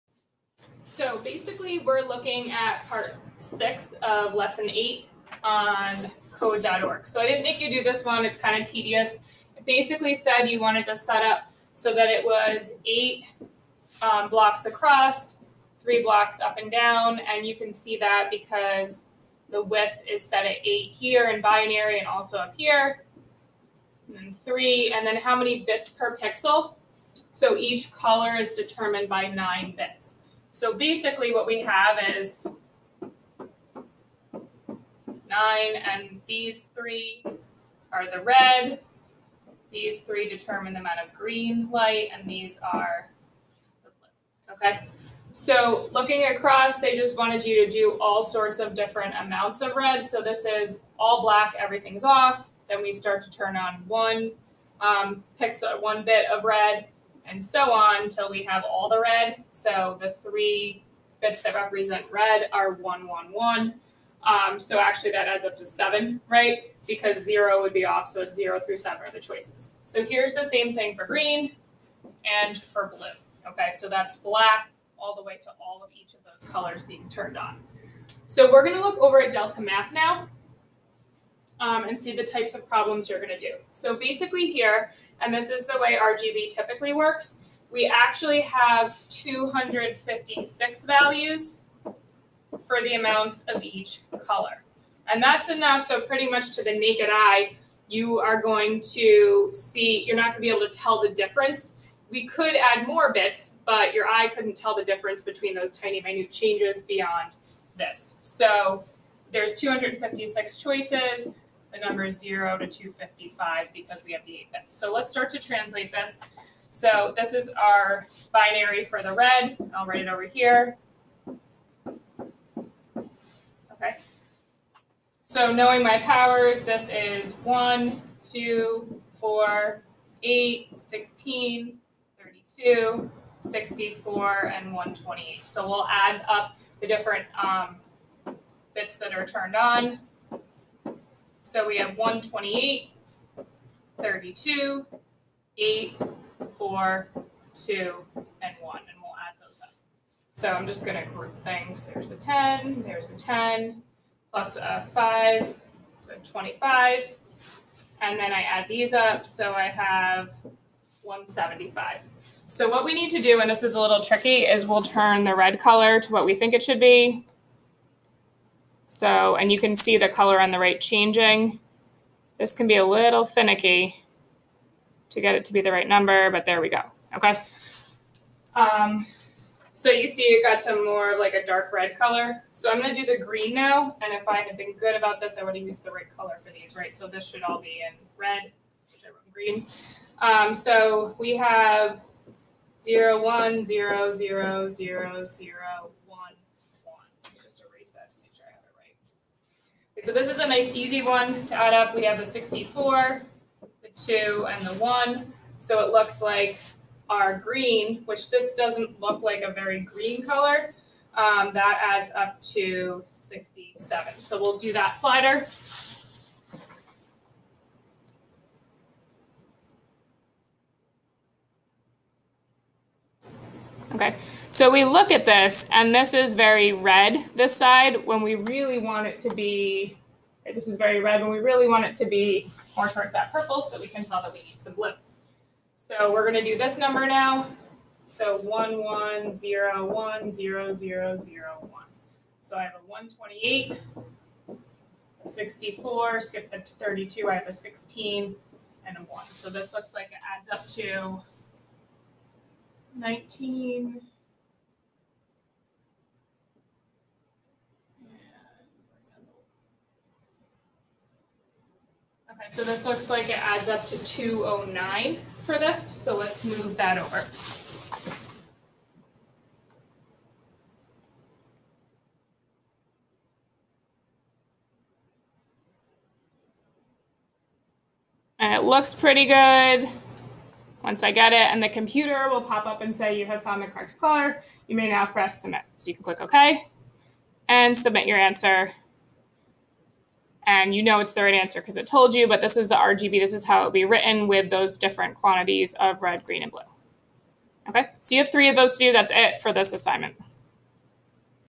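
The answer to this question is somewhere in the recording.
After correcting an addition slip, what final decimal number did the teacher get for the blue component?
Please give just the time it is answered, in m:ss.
4:24.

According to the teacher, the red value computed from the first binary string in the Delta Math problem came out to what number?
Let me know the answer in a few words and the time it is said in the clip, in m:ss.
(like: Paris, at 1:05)
175, at 2:41.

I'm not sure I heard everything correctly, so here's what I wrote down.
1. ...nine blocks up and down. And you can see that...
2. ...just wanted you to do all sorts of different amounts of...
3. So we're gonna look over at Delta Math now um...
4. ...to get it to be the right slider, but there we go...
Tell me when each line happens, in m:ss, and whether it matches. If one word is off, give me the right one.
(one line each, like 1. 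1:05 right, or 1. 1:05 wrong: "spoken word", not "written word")
1. 0:15 wrong: "three", not "nine"
2. 0:46 right
3. 1:18 right
4. 2:55 wrong: "number", not "slider".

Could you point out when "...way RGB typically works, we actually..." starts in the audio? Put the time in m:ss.
1:25.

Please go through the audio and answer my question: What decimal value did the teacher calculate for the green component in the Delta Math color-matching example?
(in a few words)
67.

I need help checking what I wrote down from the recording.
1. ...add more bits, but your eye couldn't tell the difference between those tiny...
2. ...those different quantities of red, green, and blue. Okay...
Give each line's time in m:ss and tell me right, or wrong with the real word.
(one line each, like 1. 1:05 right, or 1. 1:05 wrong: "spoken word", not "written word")
1. 1:42 right
2. 4:54 right.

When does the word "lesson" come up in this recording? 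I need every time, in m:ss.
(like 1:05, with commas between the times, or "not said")
0:04.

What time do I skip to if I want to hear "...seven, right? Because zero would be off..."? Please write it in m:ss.
1:05.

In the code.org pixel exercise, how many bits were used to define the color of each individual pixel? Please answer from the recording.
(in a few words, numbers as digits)
9.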